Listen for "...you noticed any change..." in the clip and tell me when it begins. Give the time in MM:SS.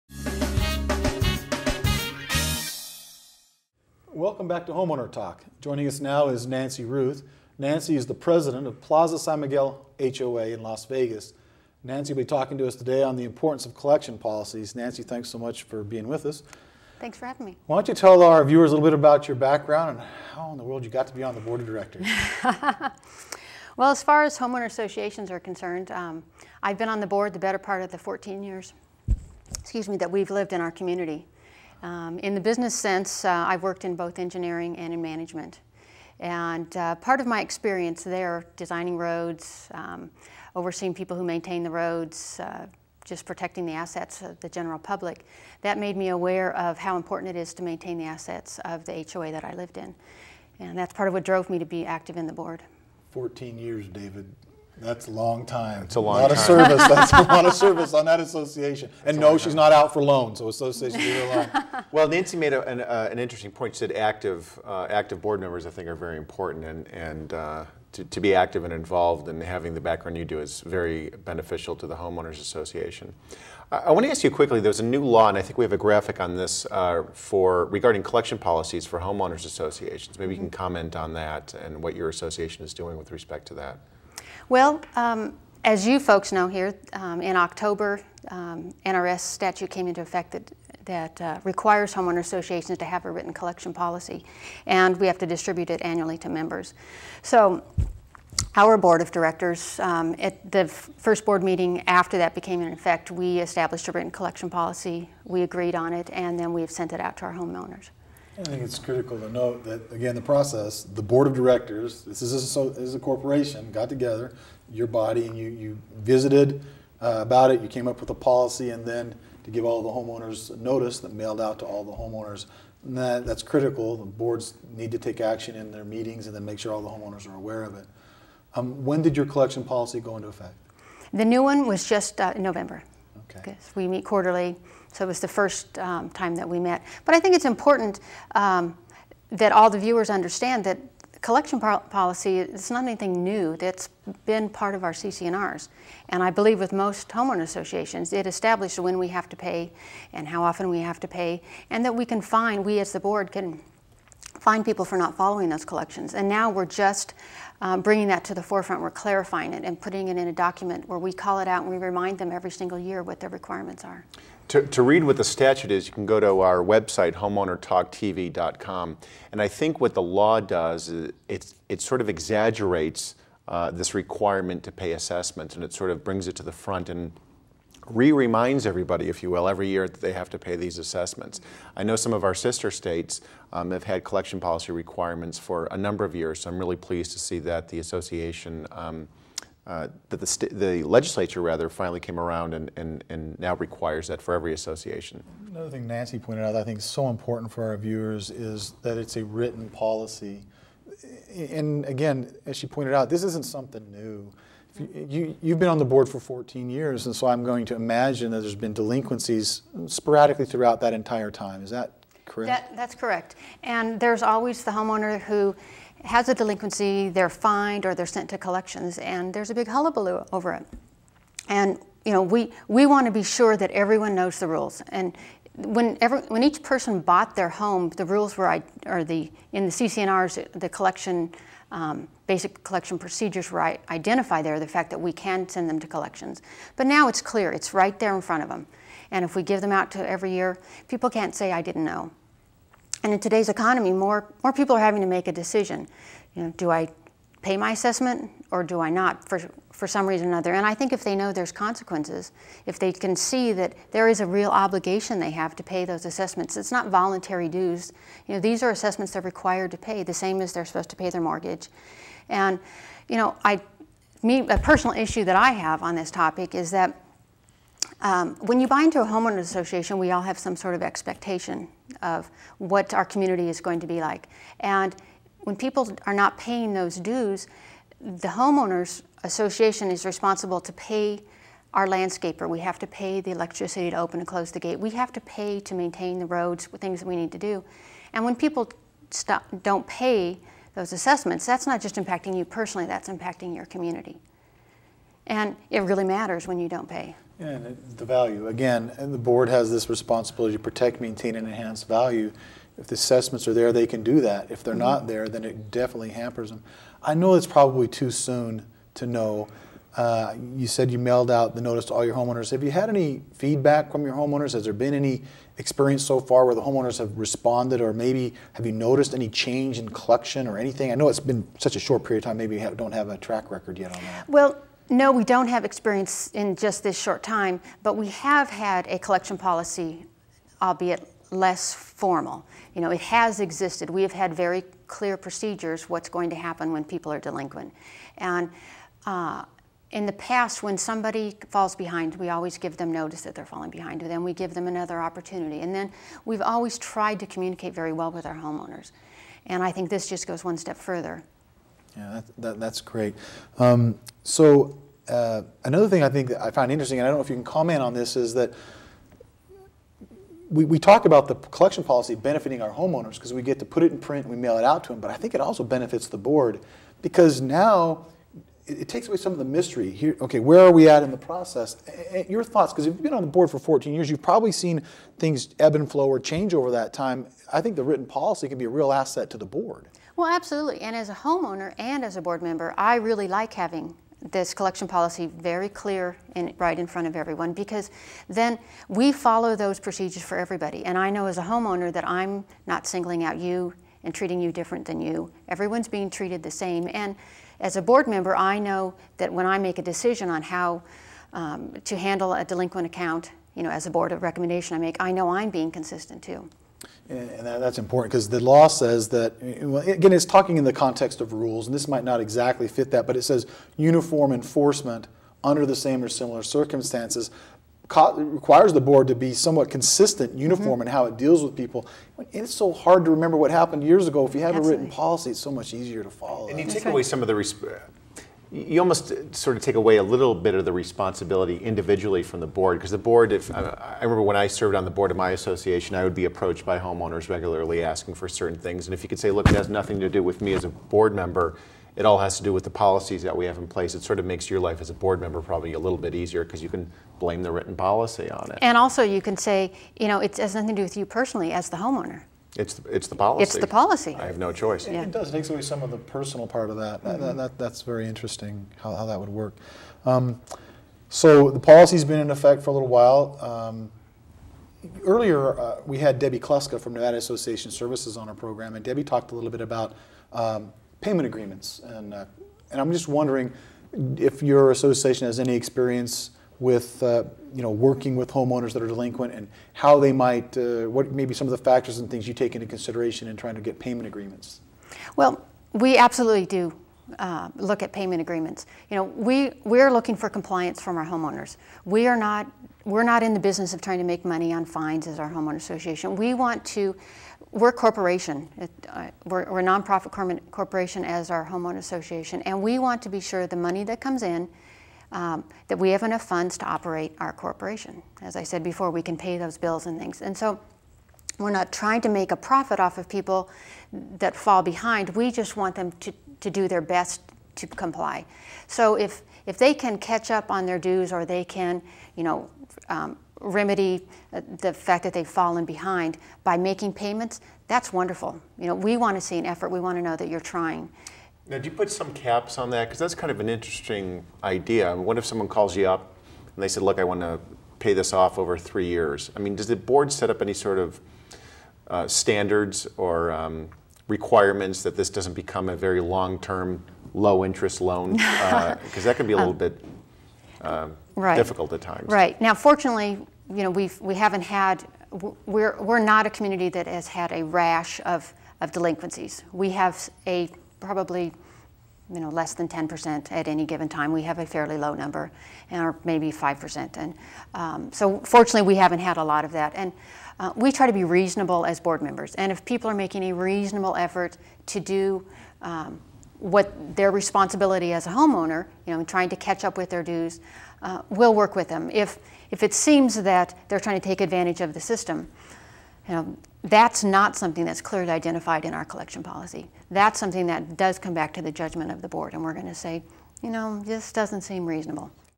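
05:18.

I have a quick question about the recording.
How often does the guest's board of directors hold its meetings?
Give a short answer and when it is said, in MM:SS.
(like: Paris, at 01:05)
quarterly, at 02:14.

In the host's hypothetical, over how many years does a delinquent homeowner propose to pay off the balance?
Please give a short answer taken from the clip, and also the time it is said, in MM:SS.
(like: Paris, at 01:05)
3 years, at 08:58.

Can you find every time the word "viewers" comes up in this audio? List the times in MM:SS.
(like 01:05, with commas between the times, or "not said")
00:18, 02:19, 03:17.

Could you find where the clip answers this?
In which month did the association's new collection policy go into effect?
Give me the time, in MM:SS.
02:12.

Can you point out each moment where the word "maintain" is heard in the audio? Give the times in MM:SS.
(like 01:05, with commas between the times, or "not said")
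00:41, 00:47, 04:45, 05:01.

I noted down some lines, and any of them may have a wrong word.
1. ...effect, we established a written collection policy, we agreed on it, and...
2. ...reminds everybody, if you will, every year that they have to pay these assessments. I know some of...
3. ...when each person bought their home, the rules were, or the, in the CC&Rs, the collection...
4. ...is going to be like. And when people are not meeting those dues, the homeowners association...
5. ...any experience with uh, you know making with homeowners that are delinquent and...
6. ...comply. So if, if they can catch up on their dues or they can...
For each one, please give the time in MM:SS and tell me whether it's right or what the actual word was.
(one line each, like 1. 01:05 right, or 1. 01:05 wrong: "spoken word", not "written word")
1. 01:42 right
2. 02:58 right
3. 03:46 right
4. 04:33 wrong: "paying", not "meeting"
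5. 07:55 wrong: "working", not "making"
6. 08:37 right.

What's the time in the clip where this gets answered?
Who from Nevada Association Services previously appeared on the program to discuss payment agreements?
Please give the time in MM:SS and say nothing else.
07:46.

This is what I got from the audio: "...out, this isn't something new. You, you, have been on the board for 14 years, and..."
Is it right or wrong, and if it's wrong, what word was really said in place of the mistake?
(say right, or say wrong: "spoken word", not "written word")
right.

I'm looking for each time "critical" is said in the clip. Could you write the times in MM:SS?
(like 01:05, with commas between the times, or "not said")
01:48, 02:03.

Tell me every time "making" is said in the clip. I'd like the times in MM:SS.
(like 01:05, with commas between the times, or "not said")
08:46, 09:32.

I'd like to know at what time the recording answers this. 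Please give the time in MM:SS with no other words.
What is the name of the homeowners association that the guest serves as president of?
00:08.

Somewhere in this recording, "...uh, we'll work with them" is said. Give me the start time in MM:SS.
09:40.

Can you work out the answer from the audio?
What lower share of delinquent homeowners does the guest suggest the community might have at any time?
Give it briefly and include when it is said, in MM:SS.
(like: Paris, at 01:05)
5%, at 09:26.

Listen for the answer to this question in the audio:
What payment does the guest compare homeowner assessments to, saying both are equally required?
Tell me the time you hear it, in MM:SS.
04:21.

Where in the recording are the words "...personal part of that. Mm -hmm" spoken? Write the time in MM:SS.
07:35.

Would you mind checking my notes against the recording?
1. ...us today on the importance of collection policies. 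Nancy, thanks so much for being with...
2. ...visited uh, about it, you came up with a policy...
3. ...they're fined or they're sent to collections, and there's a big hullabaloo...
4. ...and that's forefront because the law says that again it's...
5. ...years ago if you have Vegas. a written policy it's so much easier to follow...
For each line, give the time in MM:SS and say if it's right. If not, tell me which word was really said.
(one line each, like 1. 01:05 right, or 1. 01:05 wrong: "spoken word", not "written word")
1. 00:12 right
2. 01:55 right
3. 03:37 right
4. 06:47 wrong: "important", not "forefront"
5. 07:03 wrong: "Absolutely", not "Vegas".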